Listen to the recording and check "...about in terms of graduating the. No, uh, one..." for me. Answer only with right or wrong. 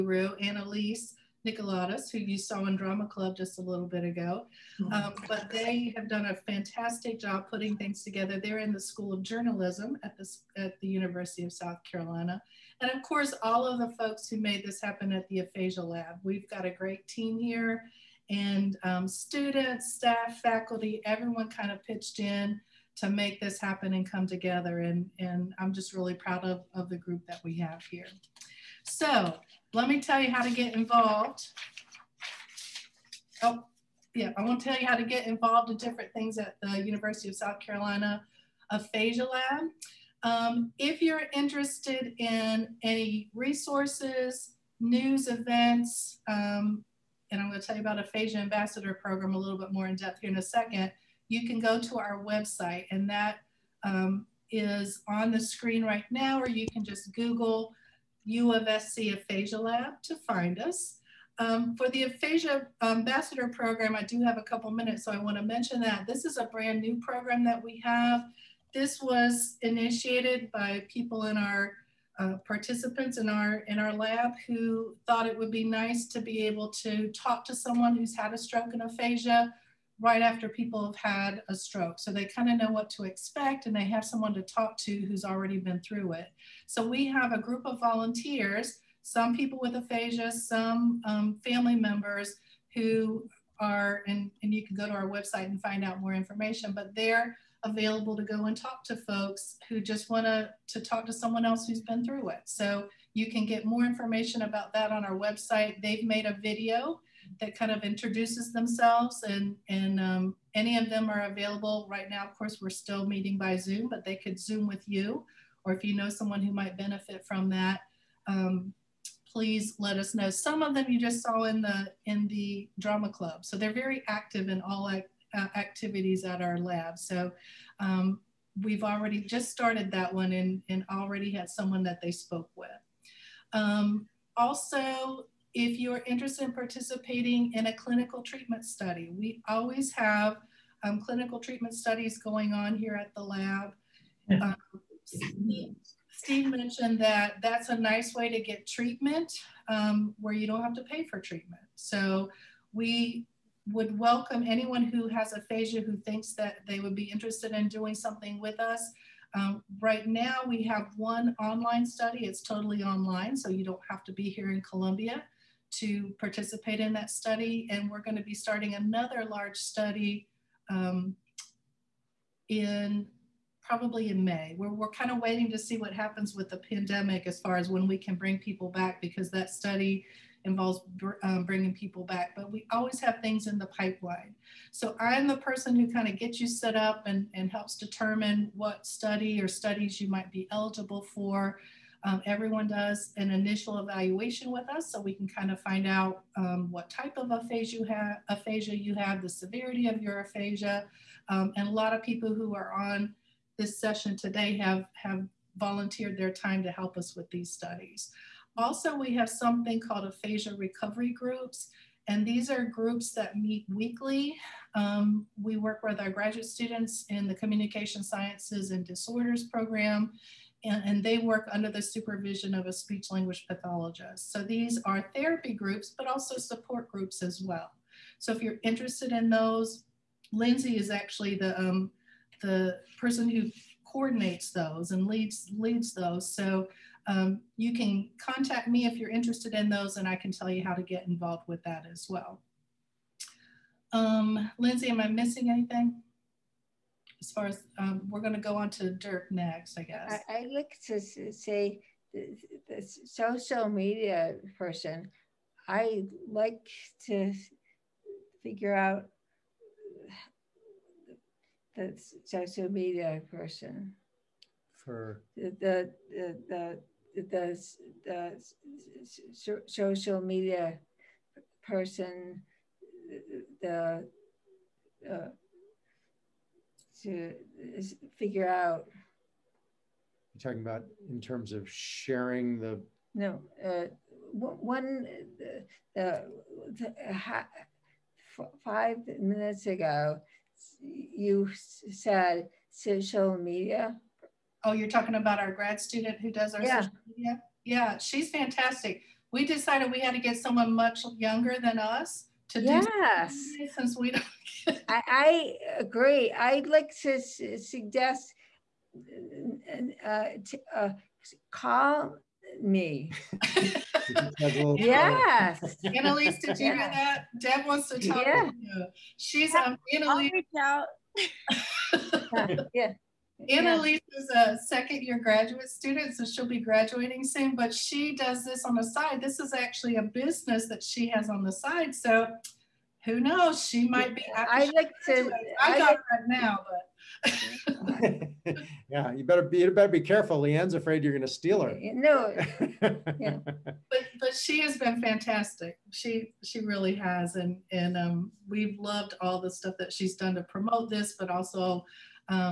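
wrong.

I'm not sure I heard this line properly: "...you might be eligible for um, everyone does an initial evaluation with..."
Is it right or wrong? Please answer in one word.
right.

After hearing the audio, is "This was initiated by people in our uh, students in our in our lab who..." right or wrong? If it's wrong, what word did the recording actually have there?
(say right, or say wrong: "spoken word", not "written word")
wrong: "participants", not "students".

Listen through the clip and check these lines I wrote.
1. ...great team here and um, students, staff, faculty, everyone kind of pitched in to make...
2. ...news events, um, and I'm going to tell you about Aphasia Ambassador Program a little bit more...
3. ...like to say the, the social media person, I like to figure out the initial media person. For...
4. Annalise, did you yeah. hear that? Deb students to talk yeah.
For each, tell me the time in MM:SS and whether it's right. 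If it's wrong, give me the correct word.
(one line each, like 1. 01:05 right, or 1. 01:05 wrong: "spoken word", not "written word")
1. 00:16 right
2. 00:44 right
3. 04:10 wrong: "social", not "initial"
4. 05:15 wrong: "wants", not "students".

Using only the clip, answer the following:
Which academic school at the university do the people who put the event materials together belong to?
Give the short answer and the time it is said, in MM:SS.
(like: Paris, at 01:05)
School of Journalism, at 00:08.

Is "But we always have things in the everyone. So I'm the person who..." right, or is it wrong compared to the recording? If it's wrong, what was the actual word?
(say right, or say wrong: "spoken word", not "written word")
wrong: "pipeline", not "everyone".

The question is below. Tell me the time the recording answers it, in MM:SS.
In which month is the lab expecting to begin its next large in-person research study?
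02:54.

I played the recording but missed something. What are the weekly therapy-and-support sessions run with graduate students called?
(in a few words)
aphasia recovery groups.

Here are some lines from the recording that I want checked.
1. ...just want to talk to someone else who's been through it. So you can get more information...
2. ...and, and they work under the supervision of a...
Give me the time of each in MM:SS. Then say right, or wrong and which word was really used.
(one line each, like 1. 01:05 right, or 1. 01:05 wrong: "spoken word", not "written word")
1. 01:39 right
2. 03:40 right.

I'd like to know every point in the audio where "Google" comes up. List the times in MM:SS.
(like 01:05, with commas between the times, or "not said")
00:57.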